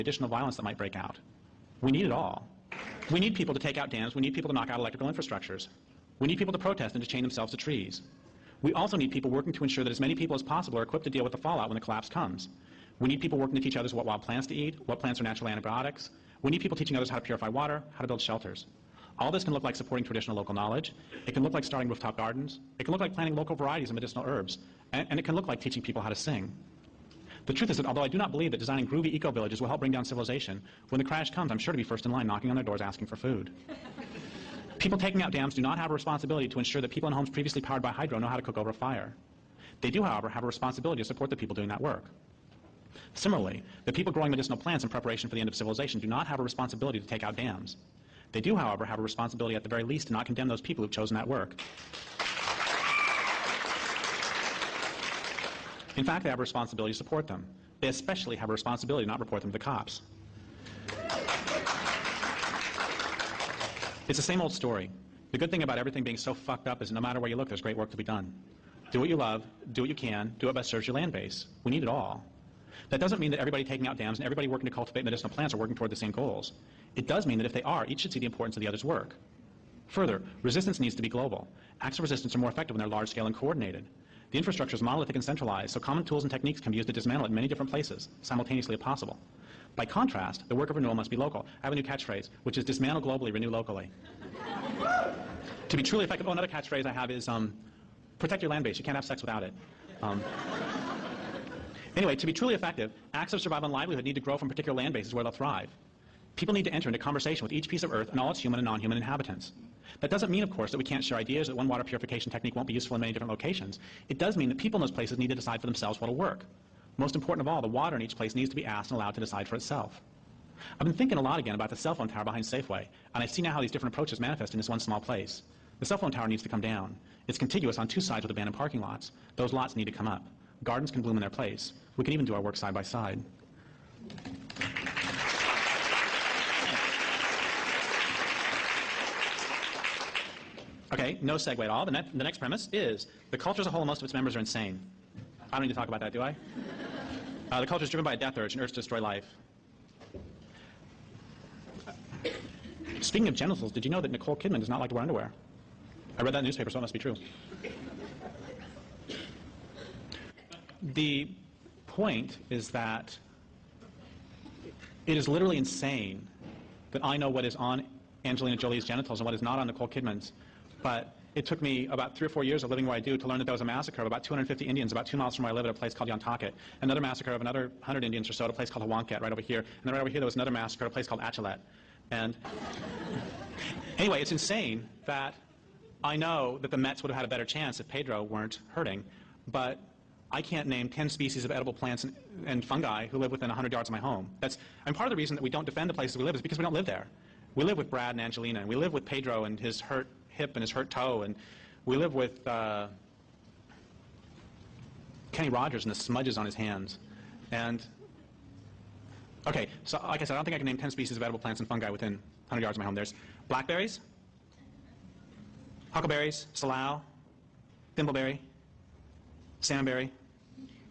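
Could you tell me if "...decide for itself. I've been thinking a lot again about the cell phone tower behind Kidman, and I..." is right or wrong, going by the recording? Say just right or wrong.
wrong.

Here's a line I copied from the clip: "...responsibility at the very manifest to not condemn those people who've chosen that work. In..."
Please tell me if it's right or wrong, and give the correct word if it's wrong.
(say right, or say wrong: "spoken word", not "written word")
wrong: "least", not "manifest".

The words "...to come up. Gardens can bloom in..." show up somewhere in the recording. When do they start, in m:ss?
2:09.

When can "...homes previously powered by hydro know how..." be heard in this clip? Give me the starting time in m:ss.
0:37.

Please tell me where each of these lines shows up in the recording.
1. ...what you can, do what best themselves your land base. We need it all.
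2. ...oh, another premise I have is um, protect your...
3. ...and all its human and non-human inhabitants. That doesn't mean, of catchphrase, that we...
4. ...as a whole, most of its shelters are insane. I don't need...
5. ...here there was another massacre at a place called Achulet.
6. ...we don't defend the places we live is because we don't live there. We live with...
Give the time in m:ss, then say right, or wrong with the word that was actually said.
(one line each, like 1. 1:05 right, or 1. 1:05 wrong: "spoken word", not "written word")
1. 1:09 wrong: "serves", not "themselves"
2. 1:36 wrong: "catchphrase", not "premise"
3. 1:48 wrong: "course", not "catchphrase"
4. 2:23 wrong: "members", not "shelters"
5. 3:00 right
6. 3:15 right.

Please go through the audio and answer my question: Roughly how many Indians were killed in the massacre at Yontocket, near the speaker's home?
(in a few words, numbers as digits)
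250.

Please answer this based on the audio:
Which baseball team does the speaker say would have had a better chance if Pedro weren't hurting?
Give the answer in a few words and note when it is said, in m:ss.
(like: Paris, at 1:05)
The Mets, at 3:06.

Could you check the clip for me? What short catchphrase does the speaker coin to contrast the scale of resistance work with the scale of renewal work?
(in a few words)
Dismantle globally, renew locally.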